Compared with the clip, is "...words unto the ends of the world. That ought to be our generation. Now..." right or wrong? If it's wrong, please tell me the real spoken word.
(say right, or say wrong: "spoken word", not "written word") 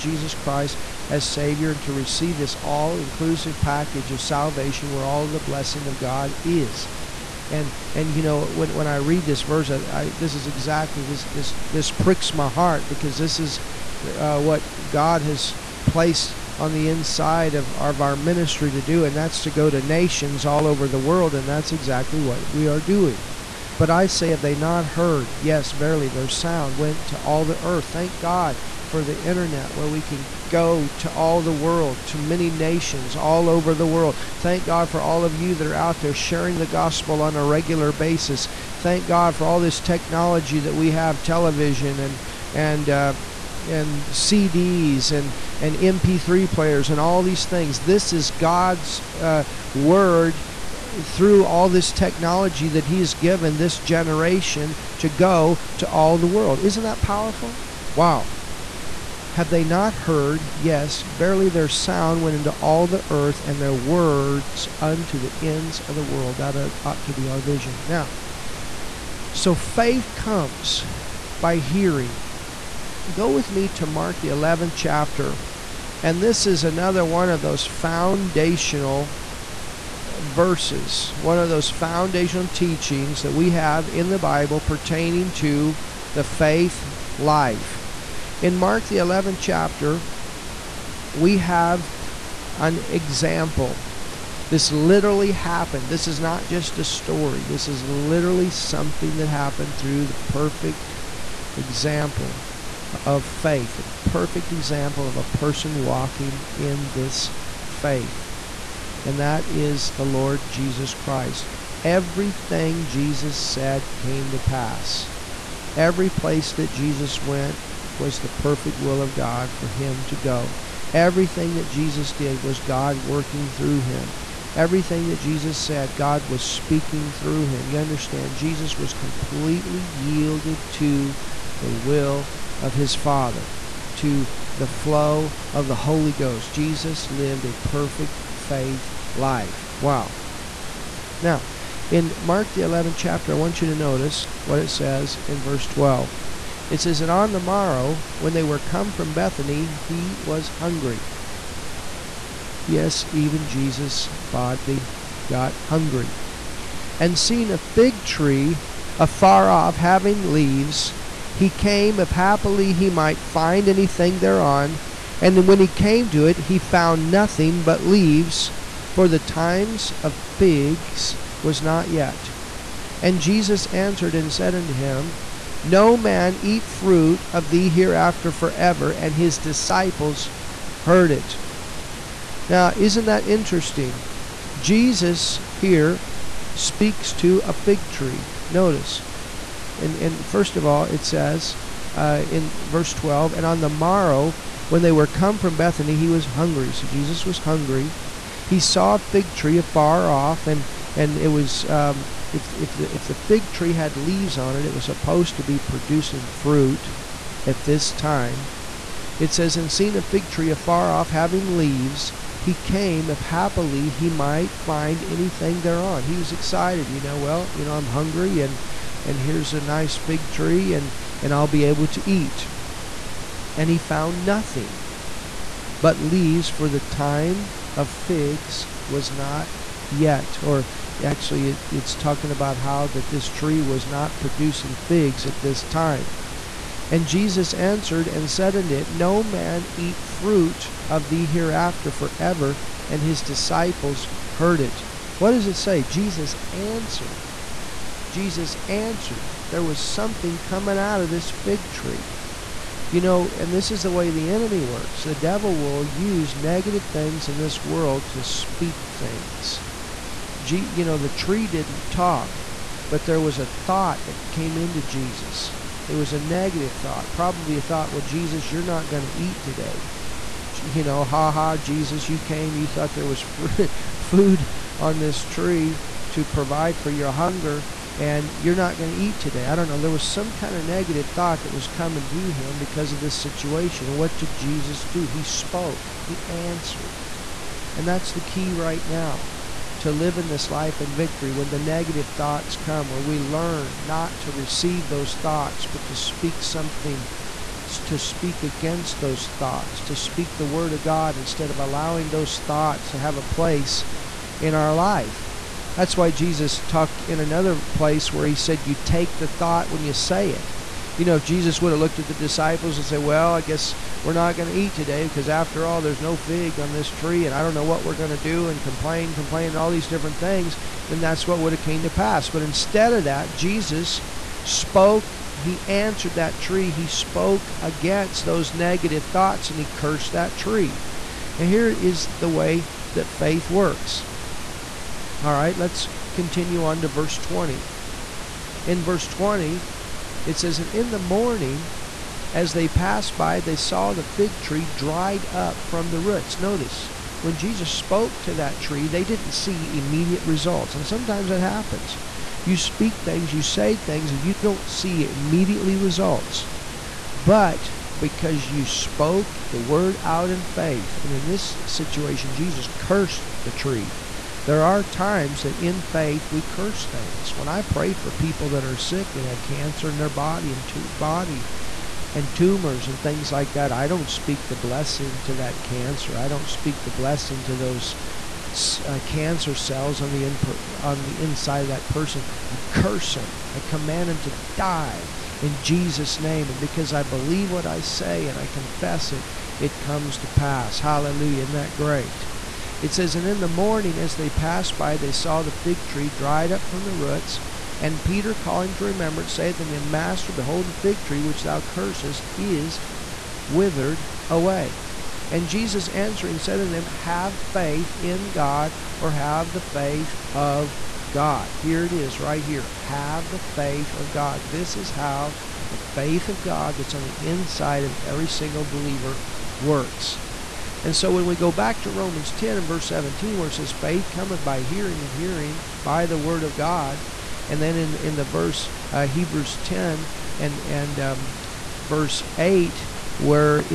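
wrong: "vision", not "generation".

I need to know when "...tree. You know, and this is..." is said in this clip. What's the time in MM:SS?
04:11.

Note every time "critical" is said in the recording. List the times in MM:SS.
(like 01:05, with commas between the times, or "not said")
not said.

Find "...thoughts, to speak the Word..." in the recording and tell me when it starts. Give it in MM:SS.
04:59.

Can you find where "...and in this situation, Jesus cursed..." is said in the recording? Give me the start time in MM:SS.
06:01.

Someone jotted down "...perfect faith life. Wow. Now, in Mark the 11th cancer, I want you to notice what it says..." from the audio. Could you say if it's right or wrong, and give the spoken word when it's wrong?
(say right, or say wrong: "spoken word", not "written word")
wrong: "chapter", not "cancer".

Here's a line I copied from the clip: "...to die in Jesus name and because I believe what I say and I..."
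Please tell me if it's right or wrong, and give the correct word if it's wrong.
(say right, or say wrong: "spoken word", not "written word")
right.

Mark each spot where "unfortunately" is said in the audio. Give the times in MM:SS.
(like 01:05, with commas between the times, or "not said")
not said.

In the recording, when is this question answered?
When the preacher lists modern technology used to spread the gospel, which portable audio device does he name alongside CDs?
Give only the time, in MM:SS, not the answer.
00:45.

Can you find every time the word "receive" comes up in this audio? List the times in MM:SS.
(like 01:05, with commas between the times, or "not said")
00:01, 04:54.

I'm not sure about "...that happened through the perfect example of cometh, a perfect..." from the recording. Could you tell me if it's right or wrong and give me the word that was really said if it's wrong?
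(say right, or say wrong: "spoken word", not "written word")
wrong: "faith", not "cometh".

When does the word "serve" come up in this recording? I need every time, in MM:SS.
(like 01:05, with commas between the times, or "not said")
not said.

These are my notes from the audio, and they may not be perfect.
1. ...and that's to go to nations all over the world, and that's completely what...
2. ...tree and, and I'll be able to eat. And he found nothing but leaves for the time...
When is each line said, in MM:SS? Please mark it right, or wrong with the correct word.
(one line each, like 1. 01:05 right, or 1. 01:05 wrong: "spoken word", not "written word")
1. 00:19 wrong: "exactly", not "completely"
2. 03:40 right.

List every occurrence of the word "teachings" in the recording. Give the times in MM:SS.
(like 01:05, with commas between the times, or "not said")
01:22.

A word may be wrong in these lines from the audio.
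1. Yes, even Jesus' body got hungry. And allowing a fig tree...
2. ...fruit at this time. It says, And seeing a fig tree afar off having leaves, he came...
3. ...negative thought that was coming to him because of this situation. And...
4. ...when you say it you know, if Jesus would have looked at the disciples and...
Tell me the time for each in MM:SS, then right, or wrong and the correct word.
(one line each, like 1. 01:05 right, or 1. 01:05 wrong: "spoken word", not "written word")
1. 02:32 wrong: "seeing", not "allowing"
2. 03:26 right
3. 04:40 right
4. 05:09 right.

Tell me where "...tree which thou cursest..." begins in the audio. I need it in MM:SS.
06:41.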